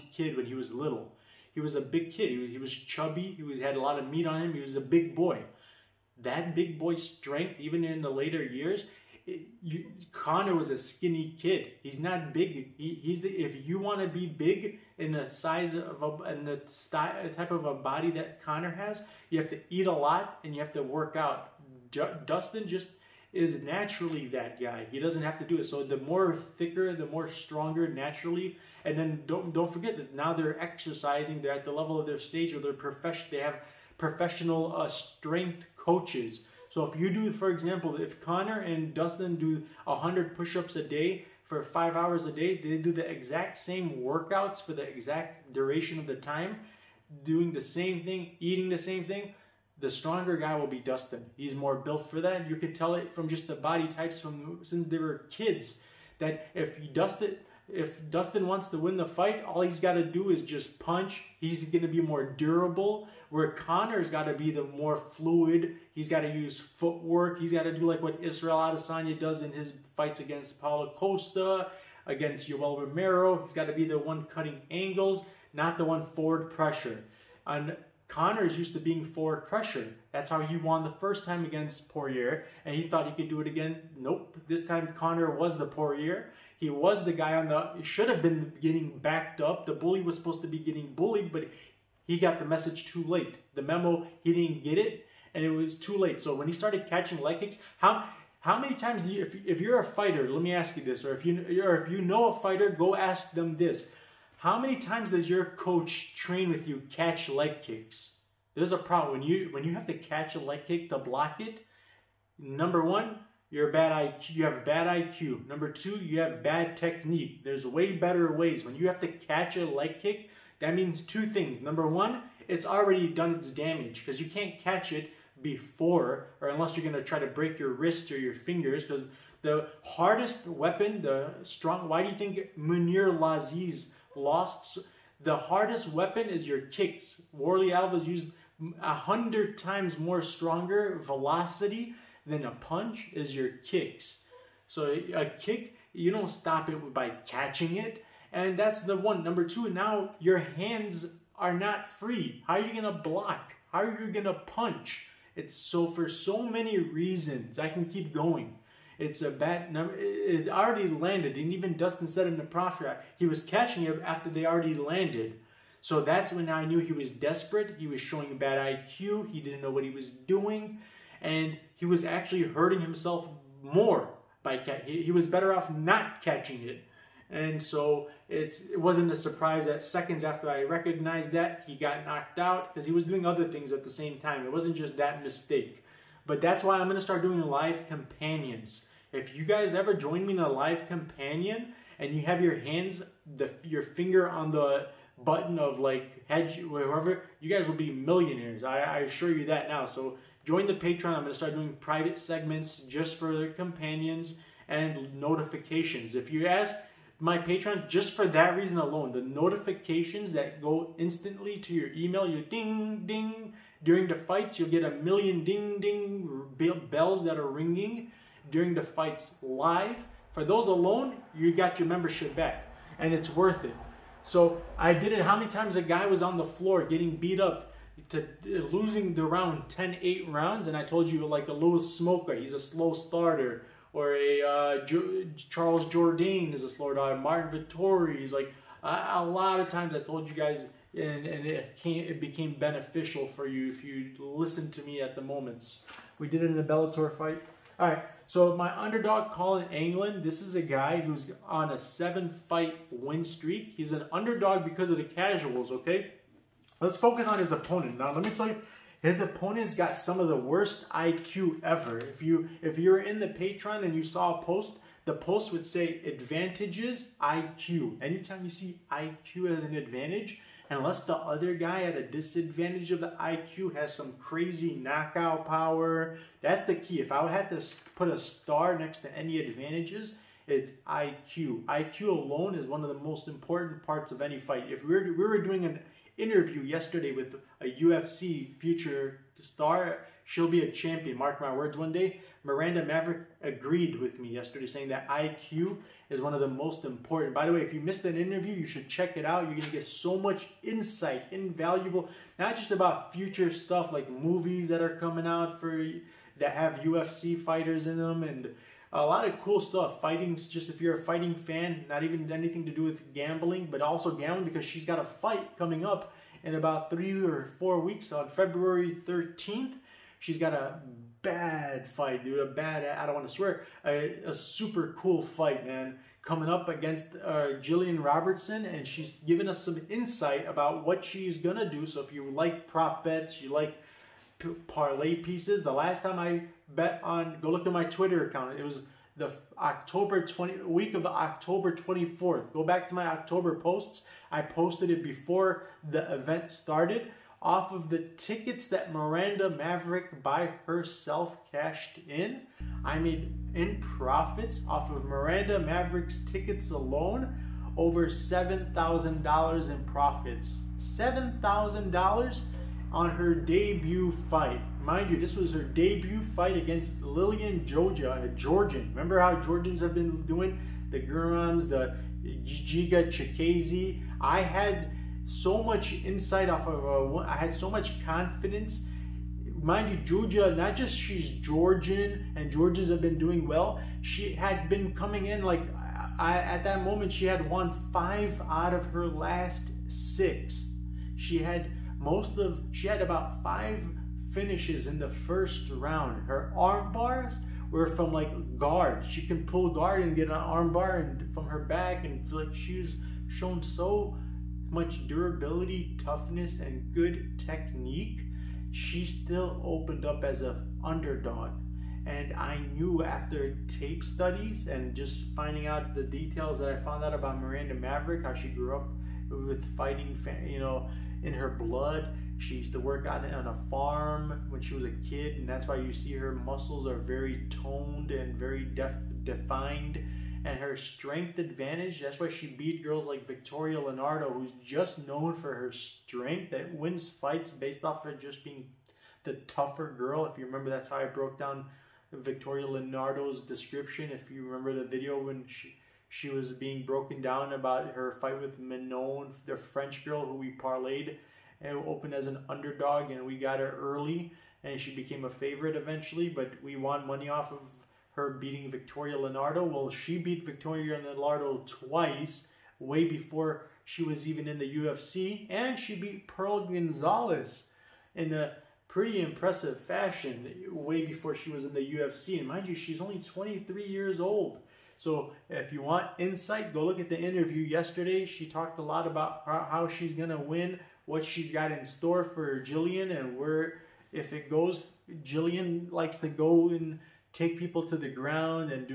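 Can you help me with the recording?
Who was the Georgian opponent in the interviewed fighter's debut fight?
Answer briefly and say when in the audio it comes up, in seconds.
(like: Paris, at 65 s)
Liana Jojua, at 367 s.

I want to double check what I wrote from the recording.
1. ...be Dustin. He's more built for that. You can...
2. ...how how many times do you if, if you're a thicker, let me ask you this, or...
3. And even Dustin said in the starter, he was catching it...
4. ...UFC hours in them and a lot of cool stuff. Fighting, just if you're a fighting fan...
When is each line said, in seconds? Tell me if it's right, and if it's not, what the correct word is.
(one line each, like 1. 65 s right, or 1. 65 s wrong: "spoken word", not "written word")
1. 50 s right
2. 97 s wrong: "fighter", not "thicker"
3. 161 s wrong: "proffer", not "starter"
4. 306 s wrong: "fighters", not "hours".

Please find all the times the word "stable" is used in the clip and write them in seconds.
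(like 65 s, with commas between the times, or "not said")
not said.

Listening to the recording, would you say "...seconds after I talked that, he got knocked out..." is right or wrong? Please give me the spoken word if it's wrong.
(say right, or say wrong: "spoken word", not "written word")
wrong: "recognized", not "talked".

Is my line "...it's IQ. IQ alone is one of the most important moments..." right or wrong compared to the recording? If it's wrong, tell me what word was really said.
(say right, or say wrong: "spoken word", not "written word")
wrong: "parts", not "moments".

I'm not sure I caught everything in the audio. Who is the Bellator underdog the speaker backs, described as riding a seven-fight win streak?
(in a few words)
Collin Anglin.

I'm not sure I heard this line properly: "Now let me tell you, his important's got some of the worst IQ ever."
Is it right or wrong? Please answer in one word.
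wrong.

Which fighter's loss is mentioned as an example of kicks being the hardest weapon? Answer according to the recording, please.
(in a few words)
Mounir Lazzez.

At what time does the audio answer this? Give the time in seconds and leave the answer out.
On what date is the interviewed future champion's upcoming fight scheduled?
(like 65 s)
318 s.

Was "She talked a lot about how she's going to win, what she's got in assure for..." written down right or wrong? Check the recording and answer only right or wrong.
wrong.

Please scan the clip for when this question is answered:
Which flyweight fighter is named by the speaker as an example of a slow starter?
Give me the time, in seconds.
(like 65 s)
231 s.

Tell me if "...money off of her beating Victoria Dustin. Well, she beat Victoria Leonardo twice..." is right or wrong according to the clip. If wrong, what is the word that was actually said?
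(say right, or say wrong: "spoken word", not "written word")
wrong: "Leonardo", not "Dustin".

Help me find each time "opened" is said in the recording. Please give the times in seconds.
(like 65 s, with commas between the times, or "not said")
409 s, 451 s.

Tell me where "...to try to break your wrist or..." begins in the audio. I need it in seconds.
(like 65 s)
127 s.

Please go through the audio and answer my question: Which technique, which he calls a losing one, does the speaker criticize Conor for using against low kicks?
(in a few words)
Catching leg kicks.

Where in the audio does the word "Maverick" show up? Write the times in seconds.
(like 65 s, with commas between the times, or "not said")
292 s, 349 s, 355 s, 417 s.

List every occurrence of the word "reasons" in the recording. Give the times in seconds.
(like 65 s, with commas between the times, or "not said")
156 s, 208 s.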